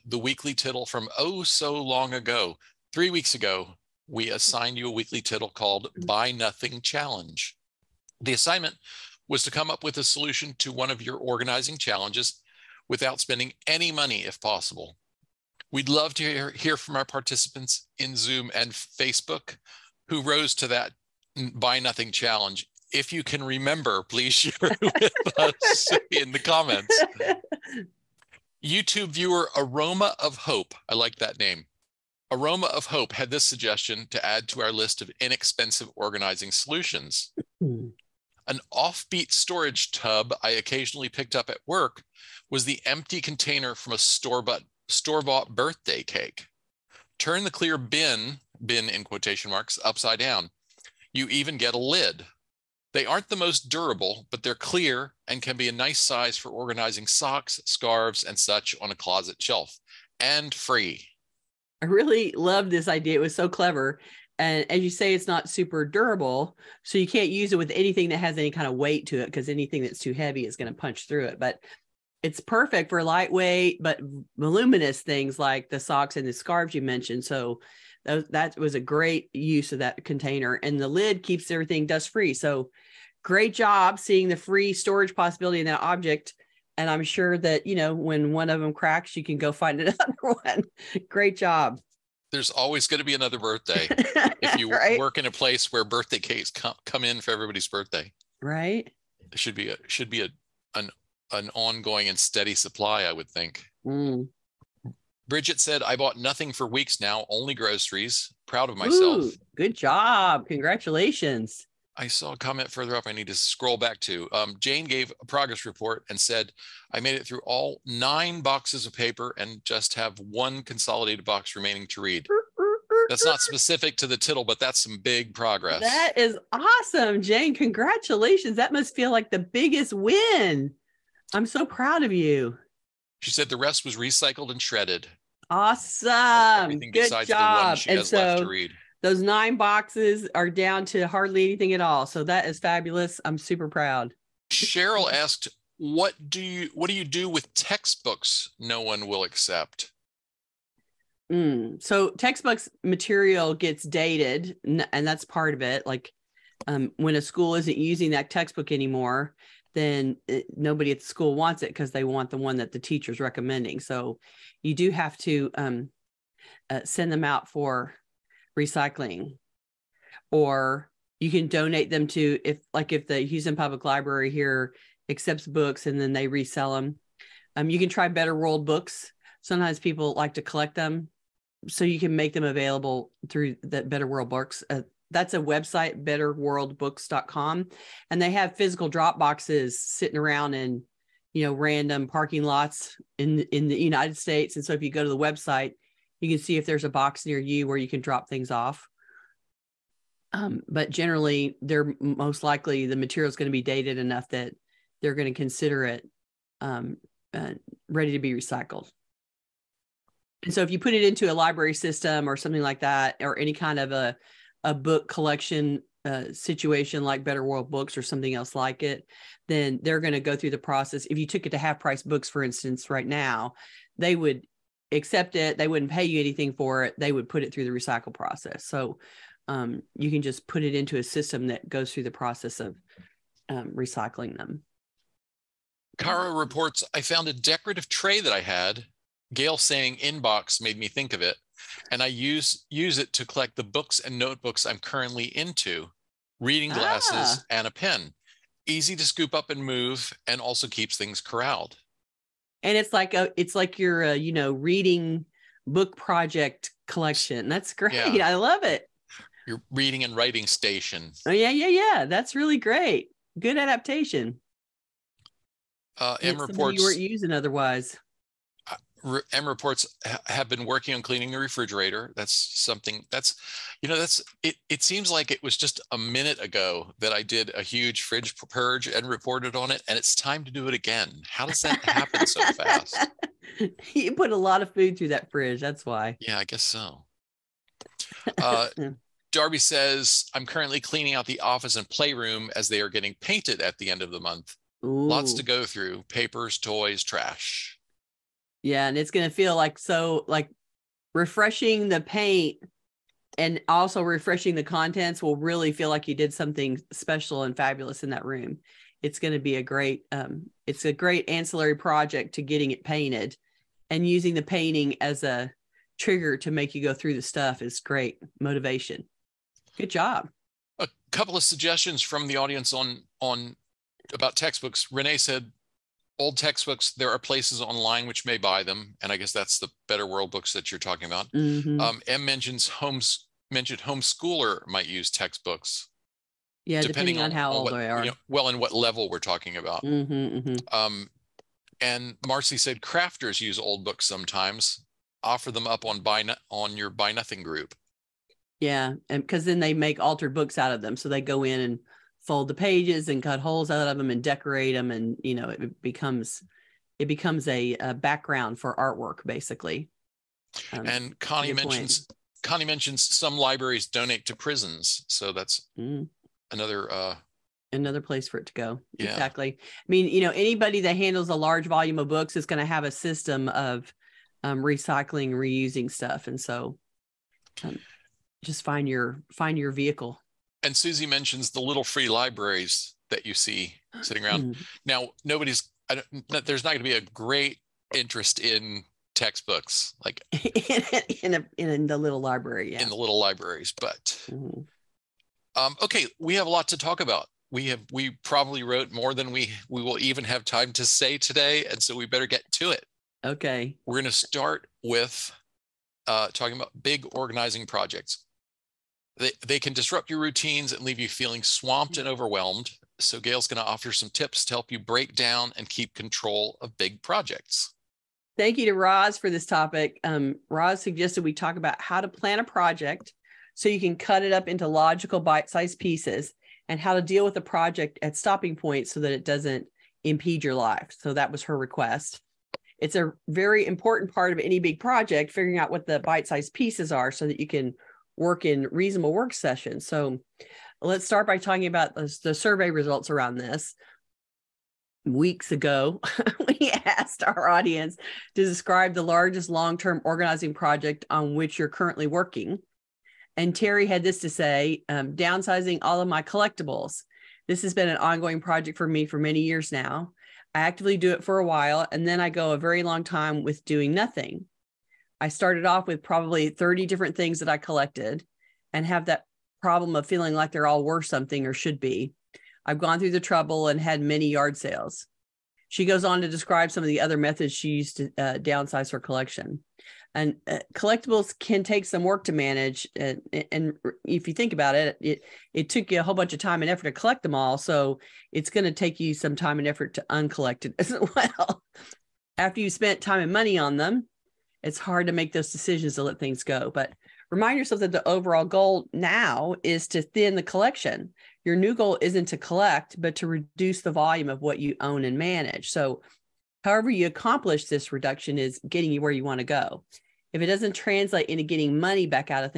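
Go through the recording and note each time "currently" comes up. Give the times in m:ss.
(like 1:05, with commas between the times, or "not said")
4:04, 4:50, 7:31.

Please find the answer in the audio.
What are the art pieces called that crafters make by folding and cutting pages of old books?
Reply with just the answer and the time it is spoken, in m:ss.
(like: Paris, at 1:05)
Altered books, at 5:50.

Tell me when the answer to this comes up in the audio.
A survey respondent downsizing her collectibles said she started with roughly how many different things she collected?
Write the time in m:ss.
7:46.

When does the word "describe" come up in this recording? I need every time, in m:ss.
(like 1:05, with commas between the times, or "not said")
7:28, 7:56.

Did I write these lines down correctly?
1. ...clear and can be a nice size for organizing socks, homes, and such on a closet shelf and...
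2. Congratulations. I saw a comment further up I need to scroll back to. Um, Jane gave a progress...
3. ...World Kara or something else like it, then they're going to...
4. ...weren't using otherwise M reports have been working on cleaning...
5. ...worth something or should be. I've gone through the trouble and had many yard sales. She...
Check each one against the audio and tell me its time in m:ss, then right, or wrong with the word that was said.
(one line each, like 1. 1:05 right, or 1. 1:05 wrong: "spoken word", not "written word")
1. 0:54 wrong: "scarves", not "homes"
2. 1:50 right
3. 3:37 wrong: "Books", not "Kara"
4. 4:26 right
5. 7:50 right.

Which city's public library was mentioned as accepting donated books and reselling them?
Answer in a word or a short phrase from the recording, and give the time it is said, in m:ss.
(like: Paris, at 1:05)
Houston, at 2:53.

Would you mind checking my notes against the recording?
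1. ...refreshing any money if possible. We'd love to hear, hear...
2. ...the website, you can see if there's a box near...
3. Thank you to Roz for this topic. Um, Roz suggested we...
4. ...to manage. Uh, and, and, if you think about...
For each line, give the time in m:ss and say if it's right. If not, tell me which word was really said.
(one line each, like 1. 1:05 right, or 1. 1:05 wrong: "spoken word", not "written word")
1. 0:13 wrong: "spending", not "refreshing"
2. 3:15 right
3. 6:58 right
4. 8:02 right.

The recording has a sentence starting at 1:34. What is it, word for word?
work in a place where birthday cakes come, come in for everybody's birthday.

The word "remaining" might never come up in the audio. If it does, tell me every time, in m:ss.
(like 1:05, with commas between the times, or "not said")
2:01.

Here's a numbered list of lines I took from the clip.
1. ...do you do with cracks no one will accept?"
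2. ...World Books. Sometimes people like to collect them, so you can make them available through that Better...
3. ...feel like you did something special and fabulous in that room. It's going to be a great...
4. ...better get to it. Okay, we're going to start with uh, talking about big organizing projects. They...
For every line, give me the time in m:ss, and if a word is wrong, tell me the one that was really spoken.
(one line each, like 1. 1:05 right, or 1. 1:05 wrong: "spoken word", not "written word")
1. 2:26 wrong: "textbooks", not "cracks"
2. 2:58 right
3. 5:05 right
4. 6:42 right.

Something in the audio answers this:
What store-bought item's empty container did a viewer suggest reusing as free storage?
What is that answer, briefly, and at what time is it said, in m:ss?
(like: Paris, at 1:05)
Birthday cake, at 0:45.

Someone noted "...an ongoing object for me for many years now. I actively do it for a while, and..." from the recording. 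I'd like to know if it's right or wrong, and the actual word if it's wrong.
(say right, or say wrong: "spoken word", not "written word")
wrong: "project", not "object".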